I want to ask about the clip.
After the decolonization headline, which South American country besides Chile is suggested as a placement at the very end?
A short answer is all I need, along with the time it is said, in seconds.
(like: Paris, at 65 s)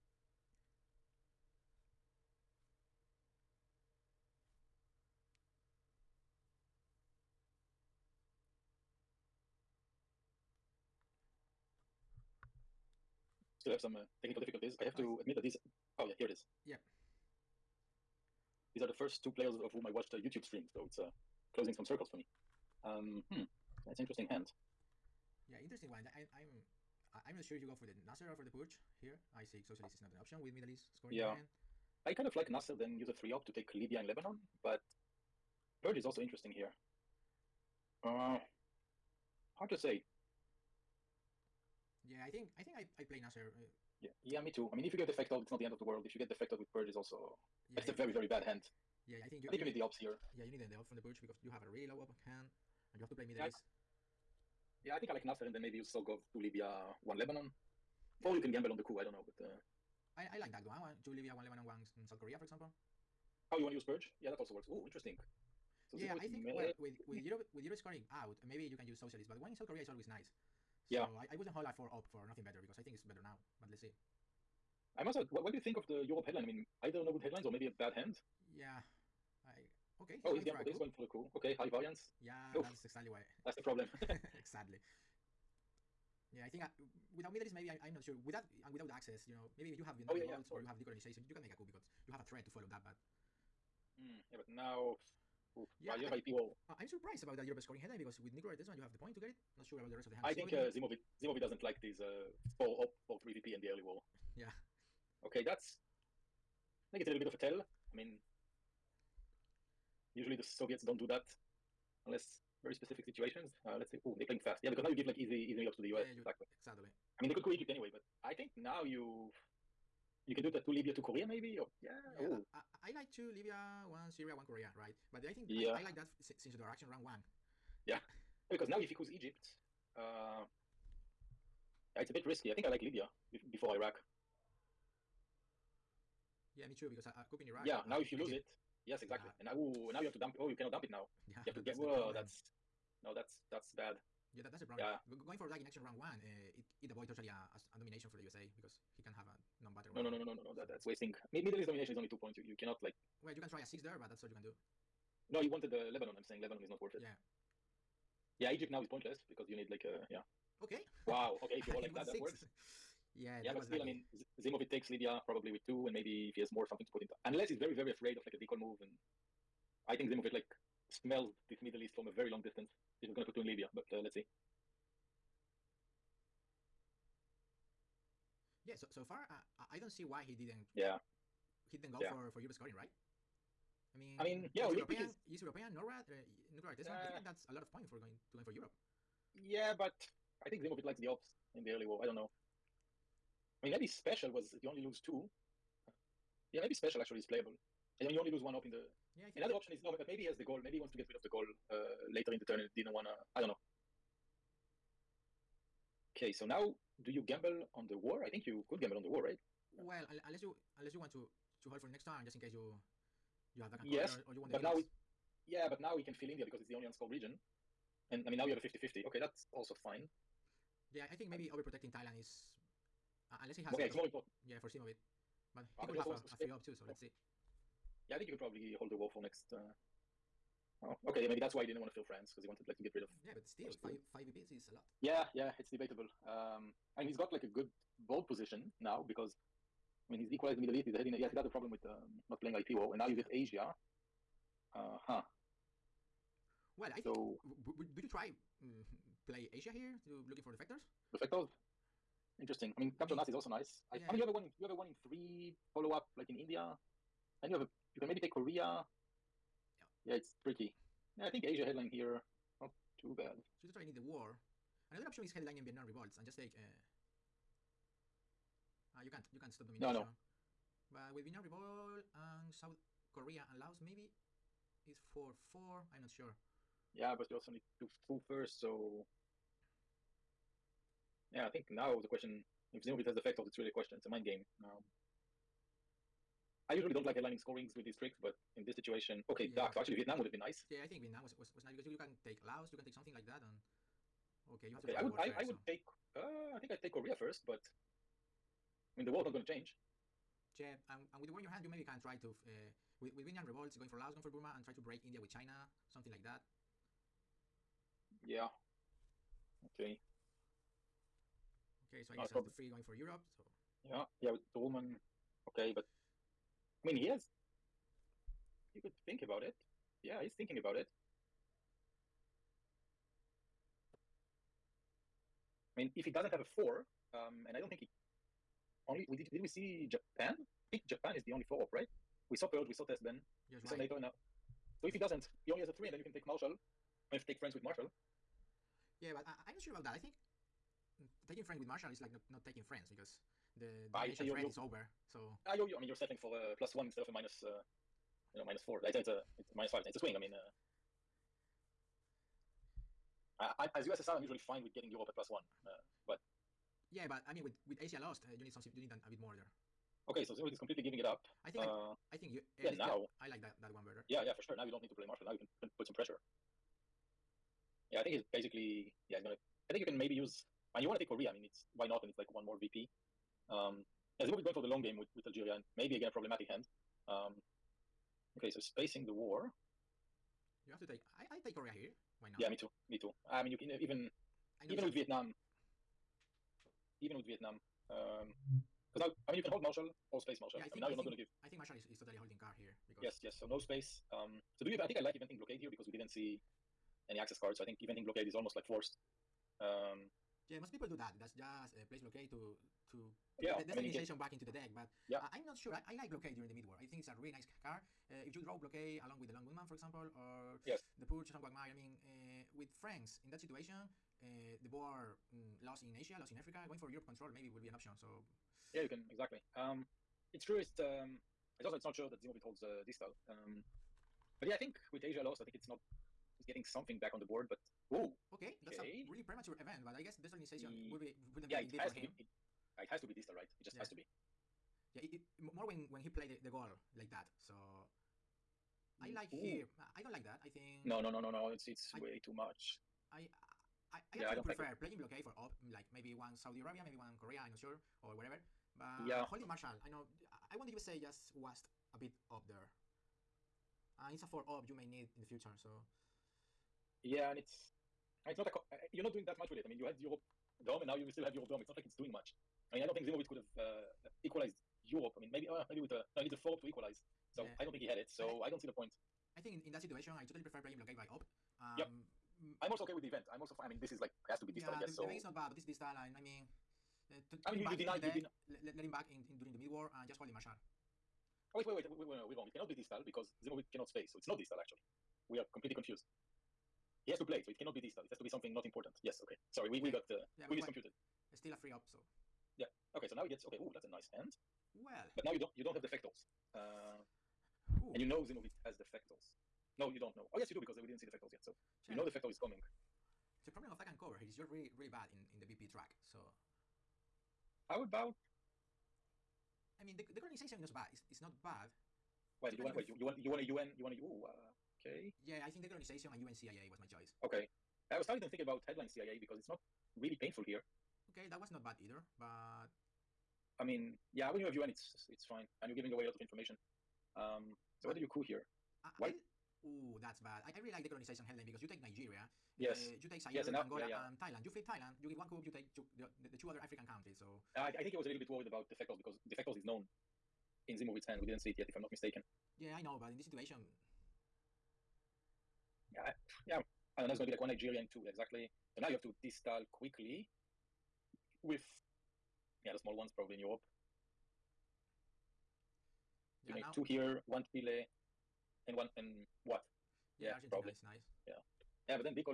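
Argentina, at 560 s.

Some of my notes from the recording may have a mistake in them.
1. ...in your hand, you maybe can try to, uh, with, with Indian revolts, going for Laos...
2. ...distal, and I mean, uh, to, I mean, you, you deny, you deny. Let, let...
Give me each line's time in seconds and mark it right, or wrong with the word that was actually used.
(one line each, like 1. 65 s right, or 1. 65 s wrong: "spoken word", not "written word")
1. 301 s right
2. 475 s right.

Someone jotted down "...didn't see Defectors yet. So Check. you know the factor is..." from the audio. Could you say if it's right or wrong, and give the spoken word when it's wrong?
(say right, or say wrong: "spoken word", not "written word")
right.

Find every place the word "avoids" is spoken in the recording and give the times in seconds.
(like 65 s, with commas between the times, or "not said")
146 s.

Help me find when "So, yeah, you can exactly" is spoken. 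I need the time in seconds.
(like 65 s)
417 s.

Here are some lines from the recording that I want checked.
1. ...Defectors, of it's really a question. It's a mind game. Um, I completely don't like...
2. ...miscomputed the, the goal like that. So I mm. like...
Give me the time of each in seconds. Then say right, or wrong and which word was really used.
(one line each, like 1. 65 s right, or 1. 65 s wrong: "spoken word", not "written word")
1. 283 s wrong: "usually", not "completely"
2. 436 s wrong: "played", not "miscomputed".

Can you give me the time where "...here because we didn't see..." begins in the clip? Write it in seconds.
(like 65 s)
395 s.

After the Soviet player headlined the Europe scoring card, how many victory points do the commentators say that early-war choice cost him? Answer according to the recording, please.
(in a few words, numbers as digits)
5.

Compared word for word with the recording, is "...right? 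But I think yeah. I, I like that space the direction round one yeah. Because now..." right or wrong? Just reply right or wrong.
wrong.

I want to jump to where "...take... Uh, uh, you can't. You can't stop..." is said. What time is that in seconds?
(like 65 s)
266 s.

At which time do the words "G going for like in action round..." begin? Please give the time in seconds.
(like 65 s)
145 s.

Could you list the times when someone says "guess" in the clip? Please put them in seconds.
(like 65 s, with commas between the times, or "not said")
312 s, 430 s, 474 s.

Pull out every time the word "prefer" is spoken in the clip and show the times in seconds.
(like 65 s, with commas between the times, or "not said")
444 s, 470 s.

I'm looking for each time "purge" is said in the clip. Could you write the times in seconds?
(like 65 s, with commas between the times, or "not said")
28 s, 35 s, 46 s, 51 s, 63 s, 332 s, 411 s.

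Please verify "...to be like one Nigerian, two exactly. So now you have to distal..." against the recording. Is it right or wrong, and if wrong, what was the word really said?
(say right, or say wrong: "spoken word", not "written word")
right.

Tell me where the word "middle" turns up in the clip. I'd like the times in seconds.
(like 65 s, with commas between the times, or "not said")
30 s, 53 s, 87 s, 151 s, 171 s, 240 s.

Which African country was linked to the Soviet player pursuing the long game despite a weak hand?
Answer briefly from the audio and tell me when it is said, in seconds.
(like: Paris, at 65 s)
Algeria, at 375 s.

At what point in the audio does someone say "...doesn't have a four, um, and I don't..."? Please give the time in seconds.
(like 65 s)
326 s.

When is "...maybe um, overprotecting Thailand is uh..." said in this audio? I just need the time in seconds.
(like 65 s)
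221 s.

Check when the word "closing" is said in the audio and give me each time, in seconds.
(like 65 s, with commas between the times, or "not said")
21 s.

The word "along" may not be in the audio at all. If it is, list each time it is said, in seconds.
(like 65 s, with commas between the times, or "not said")
409 s.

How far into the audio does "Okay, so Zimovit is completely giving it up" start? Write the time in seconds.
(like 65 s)
360 s.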